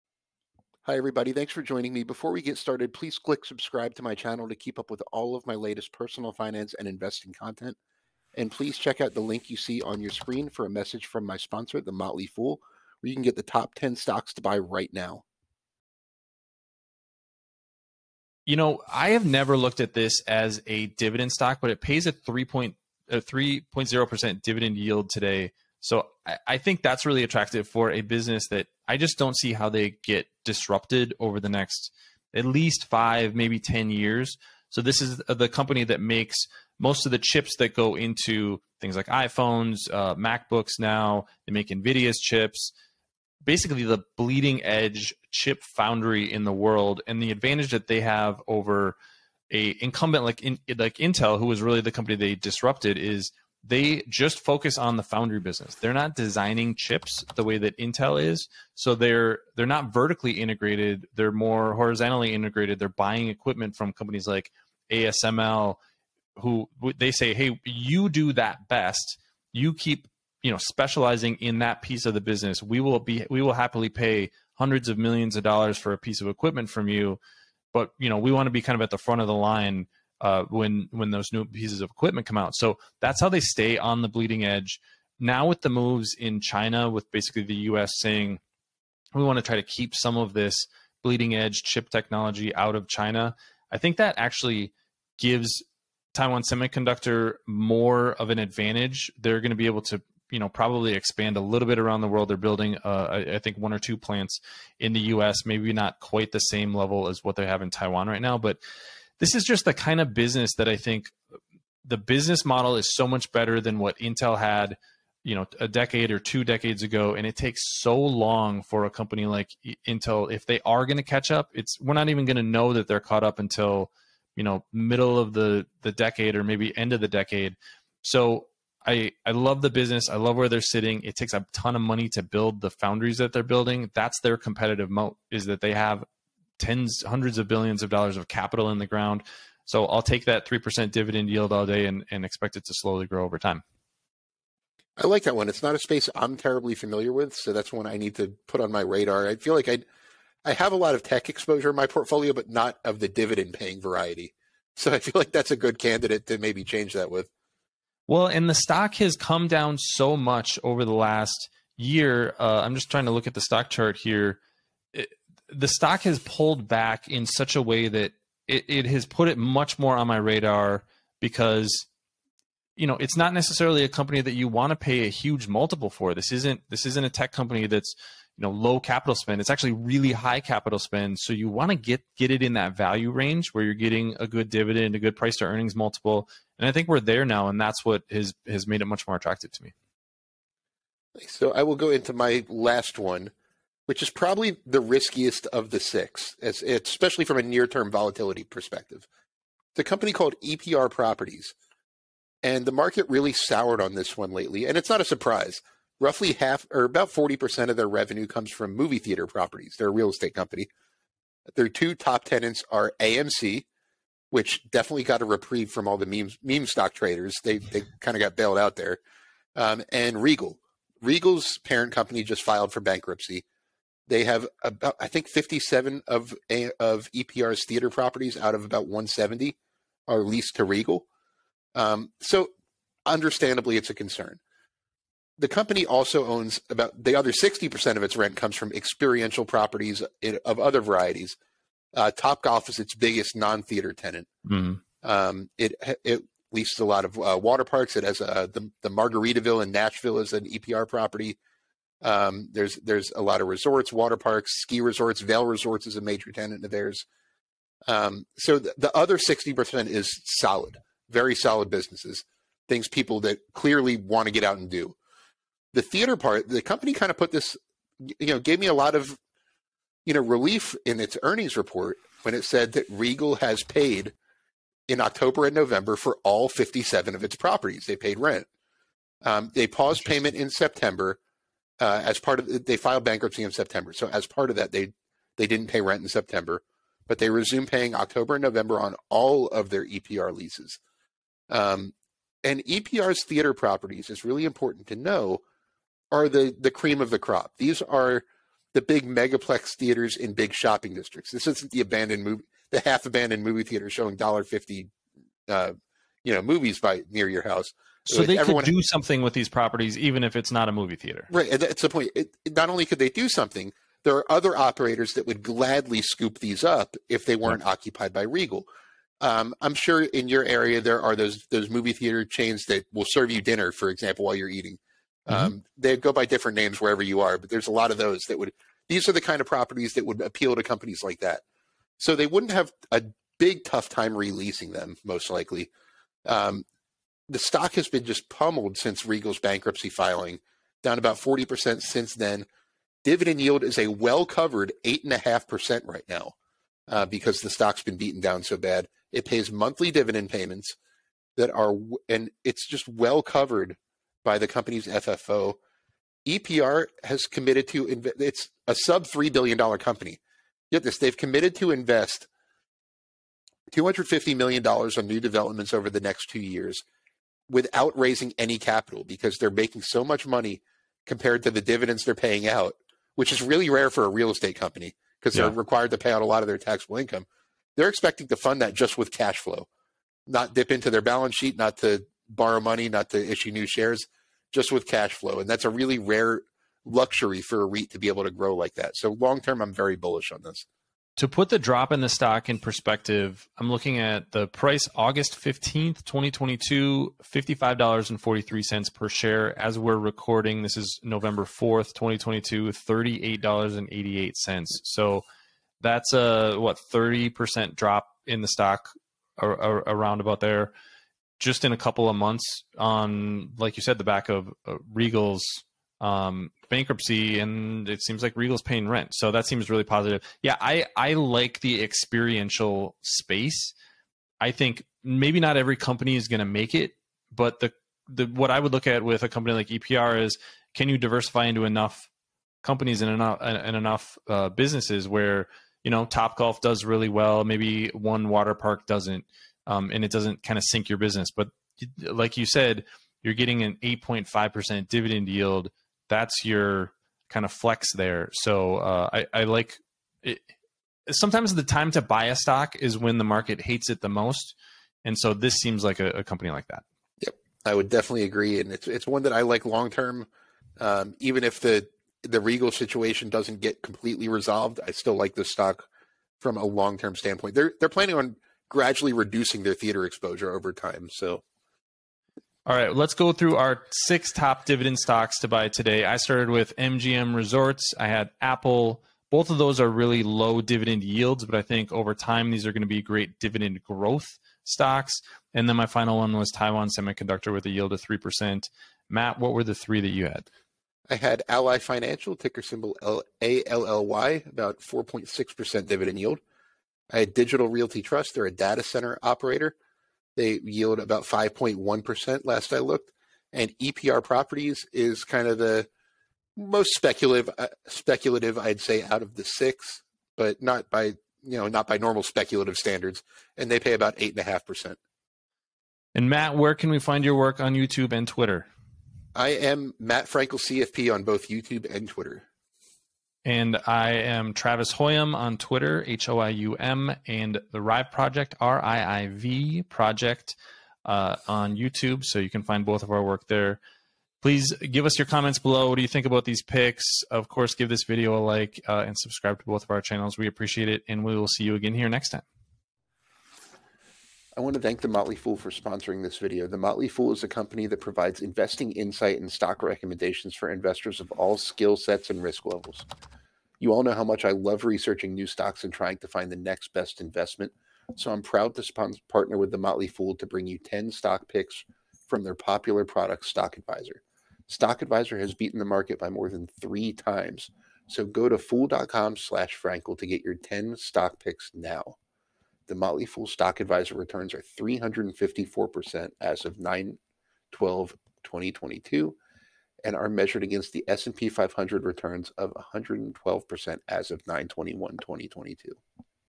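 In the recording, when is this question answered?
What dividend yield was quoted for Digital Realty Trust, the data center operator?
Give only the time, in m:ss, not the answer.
8:21.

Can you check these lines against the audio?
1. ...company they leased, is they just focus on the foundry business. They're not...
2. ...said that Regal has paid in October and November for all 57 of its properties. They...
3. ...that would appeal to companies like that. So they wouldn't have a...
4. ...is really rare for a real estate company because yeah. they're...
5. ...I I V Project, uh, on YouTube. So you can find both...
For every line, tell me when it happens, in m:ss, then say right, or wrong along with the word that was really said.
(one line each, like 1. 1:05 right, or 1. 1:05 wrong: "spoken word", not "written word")
1. 0:51 wrong: "disrupted", not "leased"
2. 4:32 right
3. 5:29 right
4. 6:13 right
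5. 8:48 right.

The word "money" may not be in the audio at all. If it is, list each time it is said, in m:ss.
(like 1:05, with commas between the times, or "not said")
2:11, 6:10, 6:22.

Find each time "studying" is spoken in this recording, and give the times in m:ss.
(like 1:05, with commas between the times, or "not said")
not said.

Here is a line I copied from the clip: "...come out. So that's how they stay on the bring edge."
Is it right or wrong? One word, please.
wrong.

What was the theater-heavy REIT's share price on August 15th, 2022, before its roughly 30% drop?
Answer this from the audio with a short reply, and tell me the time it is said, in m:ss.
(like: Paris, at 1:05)
$55.43, at 6:37.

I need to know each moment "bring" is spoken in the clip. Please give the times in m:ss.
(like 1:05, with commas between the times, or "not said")
9:20.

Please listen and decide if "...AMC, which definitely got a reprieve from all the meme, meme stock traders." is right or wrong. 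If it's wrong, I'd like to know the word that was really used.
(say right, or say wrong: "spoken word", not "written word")
right.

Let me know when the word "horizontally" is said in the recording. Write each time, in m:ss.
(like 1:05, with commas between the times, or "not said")
1:01.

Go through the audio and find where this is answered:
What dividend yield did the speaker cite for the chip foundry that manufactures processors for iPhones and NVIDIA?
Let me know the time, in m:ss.
0:22.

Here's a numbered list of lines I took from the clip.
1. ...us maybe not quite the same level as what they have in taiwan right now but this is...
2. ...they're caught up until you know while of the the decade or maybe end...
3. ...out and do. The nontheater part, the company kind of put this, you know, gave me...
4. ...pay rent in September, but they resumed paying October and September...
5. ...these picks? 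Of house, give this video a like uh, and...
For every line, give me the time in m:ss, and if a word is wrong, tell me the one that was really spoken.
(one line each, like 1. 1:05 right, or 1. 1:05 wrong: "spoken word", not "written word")
1. 1:45 right
2. 2:02 wrong: "middle", not "while"
3. 4:24 wrong: "theater", not "nontheater"
4. 4:45 wrong: "November", not "September"
5. 8:56 wrong: "course", not "house".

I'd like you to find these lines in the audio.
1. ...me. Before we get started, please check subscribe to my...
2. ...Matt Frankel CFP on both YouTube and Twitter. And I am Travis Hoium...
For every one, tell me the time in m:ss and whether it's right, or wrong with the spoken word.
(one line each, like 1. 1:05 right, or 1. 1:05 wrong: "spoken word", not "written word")
1. 0:01 wrong: "click", not "check"
2. 8:39 right.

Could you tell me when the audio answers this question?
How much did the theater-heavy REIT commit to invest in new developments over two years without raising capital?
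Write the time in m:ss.
6:03.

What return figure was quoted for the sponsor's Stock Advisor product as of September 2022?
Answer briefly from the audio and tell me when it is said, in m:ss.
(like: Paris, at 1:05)
354%, at 9:34.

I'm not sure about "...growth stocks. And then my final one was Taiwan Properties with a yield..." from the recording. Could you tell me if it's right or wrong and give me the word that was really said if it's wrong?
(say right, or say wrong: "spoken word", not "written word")
wrong: "Semiconductor", not "Properties".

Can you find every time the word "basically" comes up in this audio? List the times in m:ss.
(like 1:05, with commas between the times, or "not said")
0:43, 1:27.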